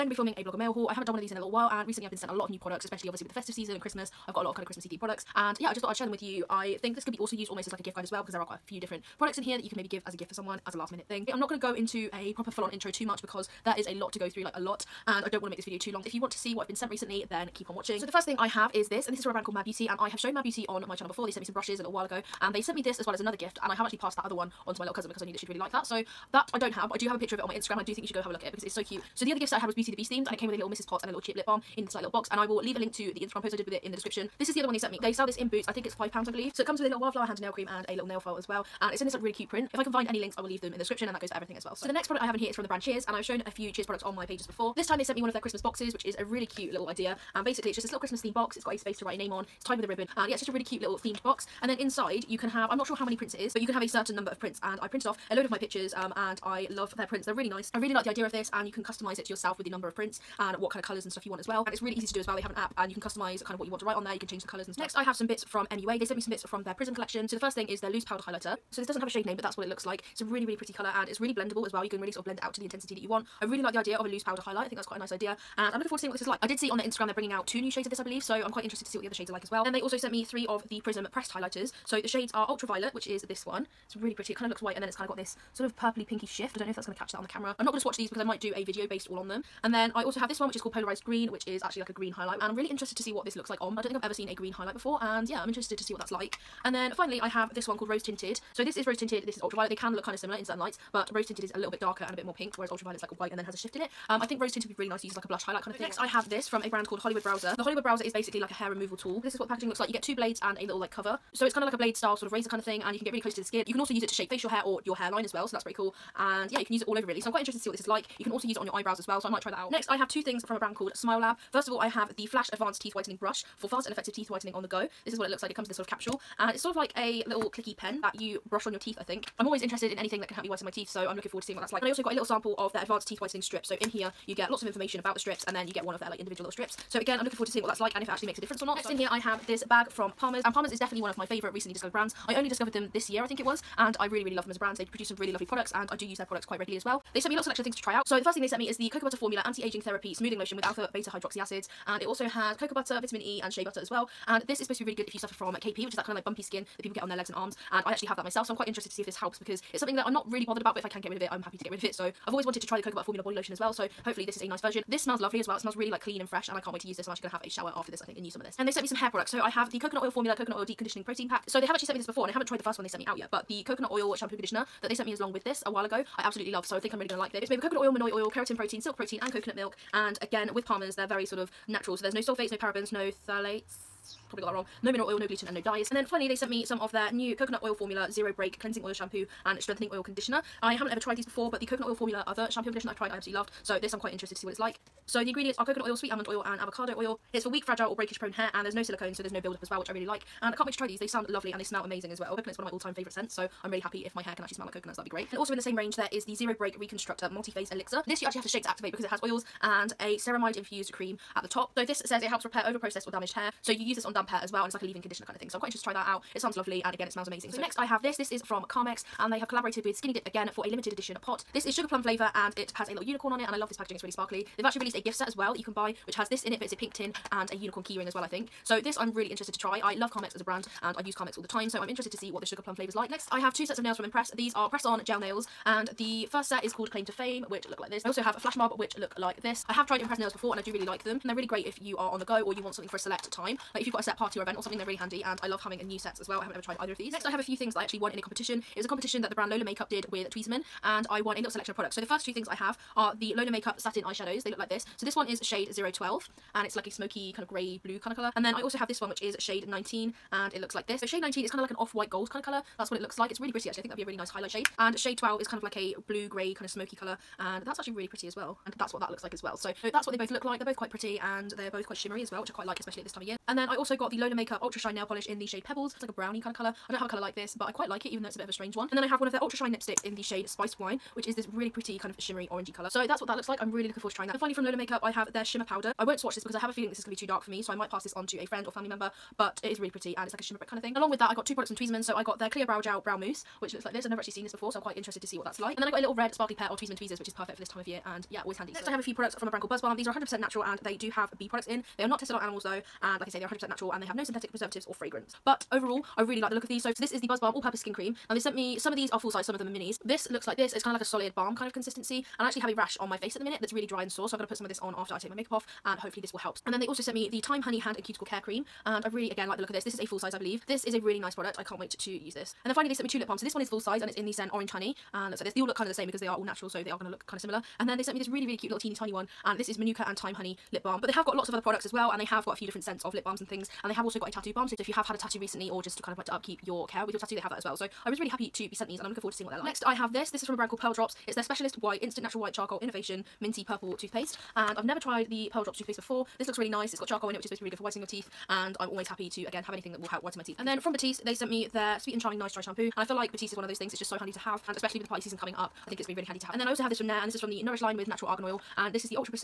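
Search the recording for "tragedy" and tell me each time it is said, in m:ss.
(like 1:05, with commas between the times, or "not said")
not said.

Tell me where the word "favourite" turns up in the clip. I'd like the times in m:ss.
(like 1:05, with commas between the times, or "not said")
2:21, 3:22.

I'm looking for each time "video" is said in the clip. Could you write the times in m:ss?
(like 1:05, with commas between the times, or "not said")
0:15, 1:28.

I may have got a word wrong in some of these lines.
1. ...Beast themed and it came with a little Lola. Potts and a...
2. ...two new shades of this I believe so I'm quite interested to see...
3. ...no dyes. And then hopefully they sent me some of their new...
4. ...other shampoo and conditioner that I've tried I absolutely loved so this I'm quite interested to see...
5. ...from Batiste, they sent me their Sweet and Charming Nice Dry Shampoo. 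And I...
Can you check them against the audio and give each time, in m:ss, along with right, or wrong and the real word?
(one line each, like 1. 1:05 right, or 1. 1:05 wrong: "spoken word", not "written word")
1. 0:29 wrong: "Mrs", not "Lola"
2. 1:17 right
3. 3:05 wrong: "finally", not "hopefully"
4. 3:12 right
5. 5:50 right.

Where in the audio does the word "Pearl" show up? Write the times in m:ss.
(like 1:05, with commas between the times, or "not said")
5:40, 5:45.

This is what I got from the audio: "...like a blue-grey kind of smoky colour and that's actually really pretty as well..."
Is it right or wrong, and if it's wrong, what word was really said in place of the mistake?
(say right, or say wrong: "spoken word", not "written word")
right.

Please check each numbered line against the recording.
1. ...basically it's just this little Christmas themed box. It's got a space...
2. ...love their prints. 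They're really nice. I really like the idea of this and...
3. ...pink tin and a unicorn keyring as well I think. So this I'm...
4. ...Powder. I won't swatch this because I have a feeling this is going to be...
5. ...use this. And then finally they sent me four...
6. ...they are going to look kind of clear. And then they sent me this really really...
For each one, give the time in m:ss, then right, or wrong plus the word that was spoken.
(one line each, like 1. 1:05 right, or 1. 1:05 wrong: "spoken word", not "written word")
1. 0:47 right
2. 0:56 right
3. 3:46 right
4. 4:45 right
5. 5:22 wrong: "two", not "four"
6. 5:26 wrong: "similar", not "clear".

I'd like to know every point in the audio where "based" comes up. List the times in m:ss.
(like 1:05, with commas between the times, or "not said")
1:28.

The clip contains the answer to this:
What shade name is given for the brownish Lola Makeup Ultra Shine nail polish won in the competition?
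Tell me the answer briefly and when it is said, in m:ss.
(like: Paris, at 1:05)
Pebbles, at 4:35.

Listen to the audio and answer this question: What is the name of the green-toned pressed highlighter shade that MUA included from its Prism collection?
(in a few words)
Polarized Green.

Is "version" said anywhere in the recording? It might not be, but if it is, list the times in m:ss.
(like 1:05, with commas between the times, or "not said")
2:44.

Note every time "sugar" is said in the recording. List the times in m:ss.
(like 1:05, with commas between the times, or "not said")
3:41, 3:52.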